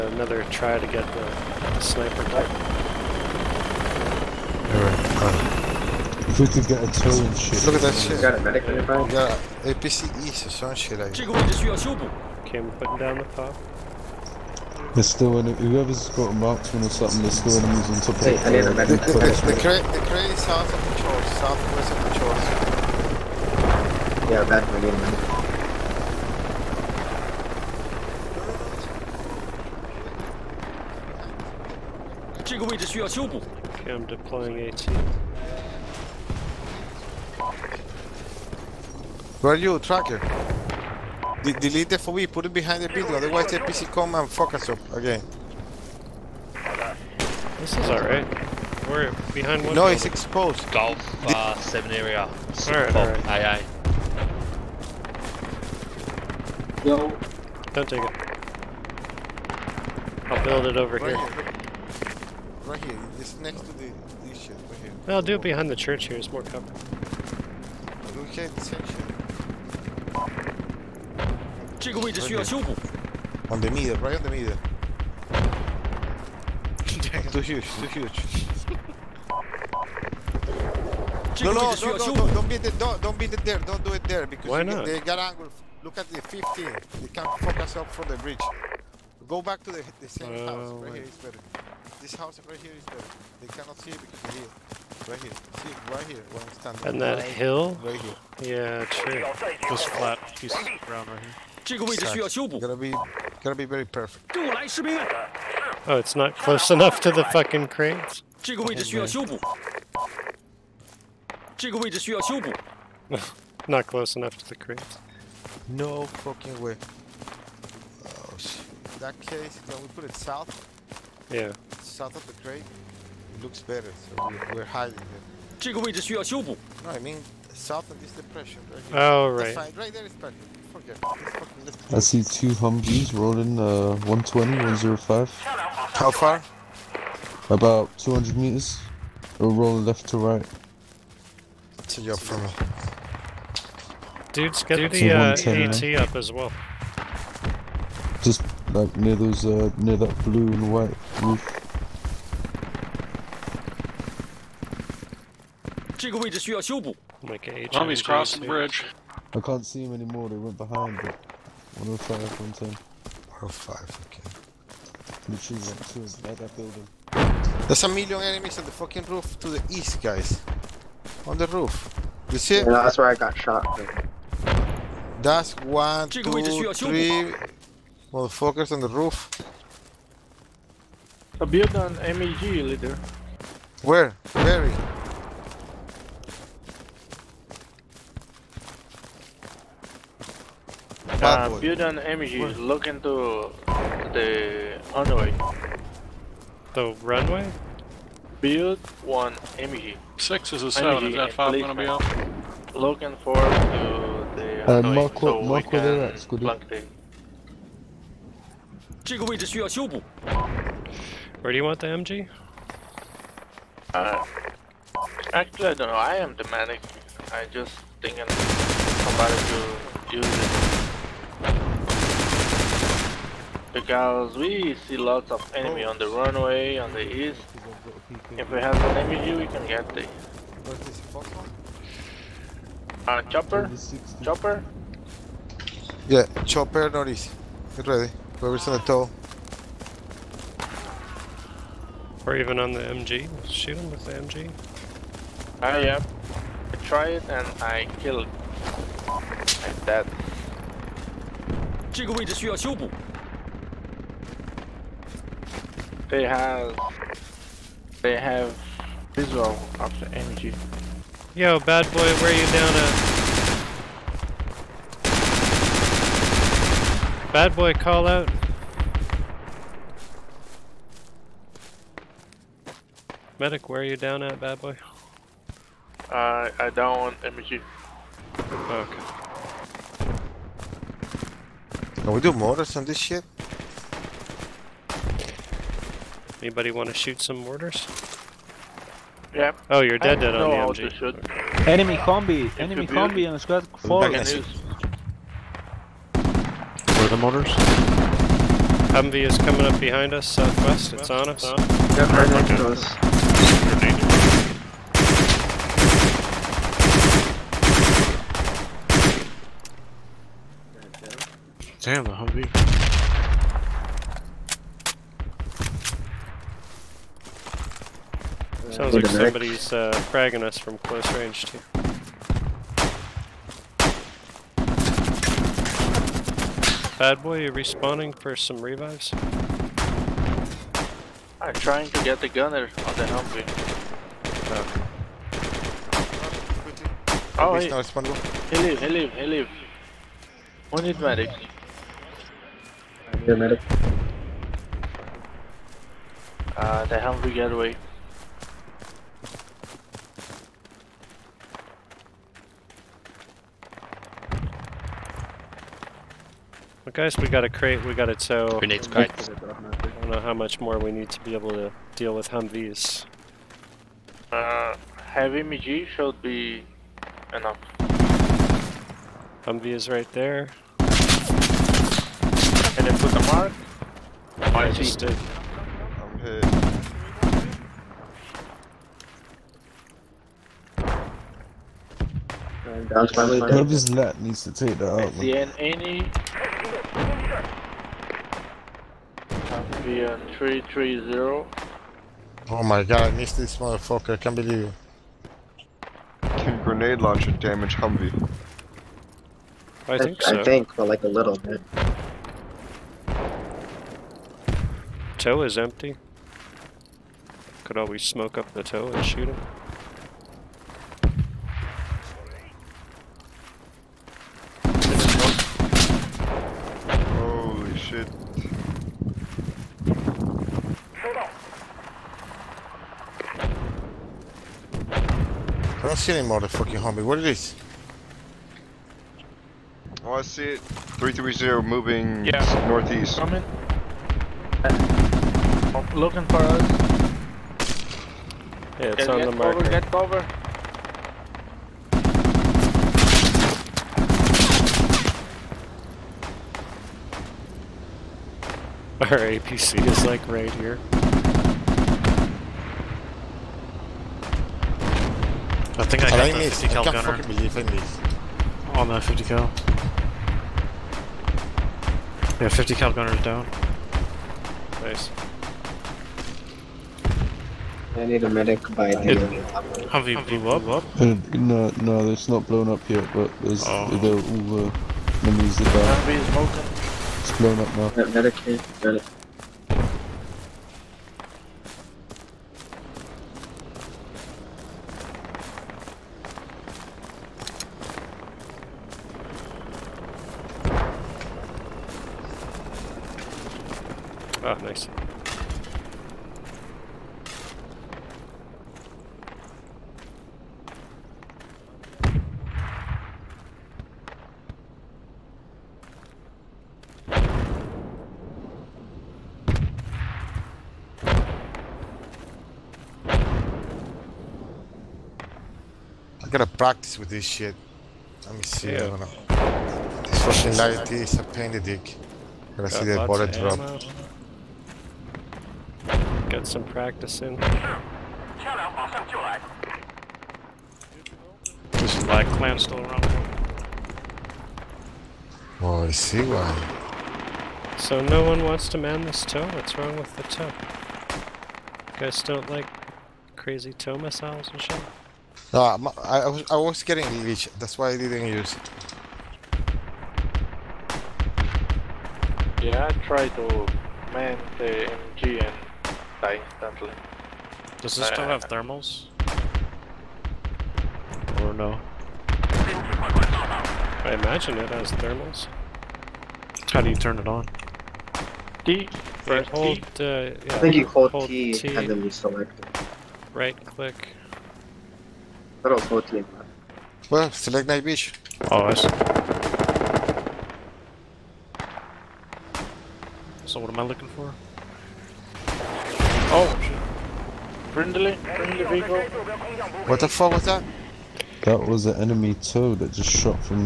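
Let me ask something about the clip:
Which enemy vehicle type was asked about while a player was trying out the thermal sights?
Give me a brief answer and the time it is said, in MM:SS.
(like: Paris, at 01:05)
Bradley, at 09:48.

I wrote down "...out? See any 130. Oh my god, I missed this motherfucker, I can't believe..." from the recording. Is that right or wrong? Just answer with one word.
wrong.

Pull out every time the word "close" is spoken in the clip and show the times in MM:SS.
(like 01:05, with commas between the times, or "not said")
01:46, 01:53, 05:20.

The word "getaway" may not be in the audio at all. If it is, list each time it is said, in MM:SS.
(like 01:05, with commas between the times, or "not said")
05:47.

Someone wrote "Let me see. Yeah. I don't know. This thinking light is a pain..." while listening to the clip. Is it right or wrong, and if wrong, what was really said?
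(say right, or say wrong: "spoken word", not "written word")
wrong: "fucking", not "thinking".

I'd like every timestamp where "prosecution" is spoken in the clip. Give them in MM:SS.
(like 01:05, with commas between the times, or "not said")
not said.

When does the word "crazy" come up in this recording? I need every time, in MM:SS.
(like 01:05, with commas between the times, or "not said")
09:03.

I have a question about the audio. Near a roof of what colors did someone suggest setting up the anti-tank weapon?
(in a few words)
blue and white.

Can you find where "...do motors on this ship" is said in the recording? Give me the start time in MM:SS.
04:42.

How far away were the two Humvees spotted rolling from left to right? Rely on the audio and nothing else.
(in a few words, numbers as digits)
About 200 meters.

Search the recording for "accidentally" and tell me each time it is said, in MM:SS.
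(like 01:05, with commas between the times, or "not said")
09:16.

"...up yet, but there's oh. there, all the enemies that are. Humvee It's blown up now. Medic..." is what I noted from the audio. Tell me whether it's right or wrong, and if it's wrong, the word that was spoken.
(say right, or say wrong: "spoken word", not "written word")
right.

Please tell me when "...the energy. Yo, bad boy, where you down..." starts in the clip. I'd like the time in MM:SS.
04:20.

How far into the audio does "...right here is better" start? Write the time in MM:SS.
01:32.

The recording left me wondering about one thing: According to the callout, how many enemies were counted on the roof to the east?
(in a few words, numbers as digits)
3.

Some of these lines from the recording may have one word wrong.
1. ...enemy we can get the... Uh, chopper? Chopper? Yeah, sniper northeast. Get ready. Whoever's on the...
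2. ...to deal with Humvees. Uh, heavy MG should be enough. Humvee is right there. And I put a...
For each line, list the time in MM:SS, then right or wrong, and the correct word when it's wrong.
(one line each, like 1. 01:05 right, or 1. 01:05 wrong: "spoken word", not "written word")
1. 03:48 wrong: "chopper", not "sniper"
2. 06:01 right.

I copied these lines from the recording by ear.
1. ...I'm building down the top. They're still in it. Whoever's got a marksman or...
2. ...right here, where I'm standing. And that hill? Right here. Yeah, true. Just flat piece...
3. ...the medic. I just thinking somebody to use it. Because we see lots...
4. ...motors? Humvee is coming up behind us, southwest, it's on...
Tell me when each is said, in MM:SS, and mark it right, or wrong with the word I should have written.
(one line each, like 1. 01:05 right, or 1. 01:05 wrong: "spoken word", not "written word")
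1. 00:12 wrong: "putting", not "building"
2. 01:35 right
3. 03:36 right
4. 04:57 wrong: "mortars", not "motors".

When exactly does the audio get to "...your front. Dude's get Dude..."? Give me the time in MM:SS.
02:22.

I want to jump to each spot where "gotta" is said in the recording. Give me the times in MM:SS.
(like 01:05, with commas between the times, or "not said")
01:42, 08:36, 08:42.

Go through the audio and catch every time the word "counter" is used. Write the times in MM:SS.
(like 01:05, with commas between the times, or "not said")
not said.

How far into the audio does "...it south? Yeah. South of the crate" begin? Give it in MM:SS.
02:00.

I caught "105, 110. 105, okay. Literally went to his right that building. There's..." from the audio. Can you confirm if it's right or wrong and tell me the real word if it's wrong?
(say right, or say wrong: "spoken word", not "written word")
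right.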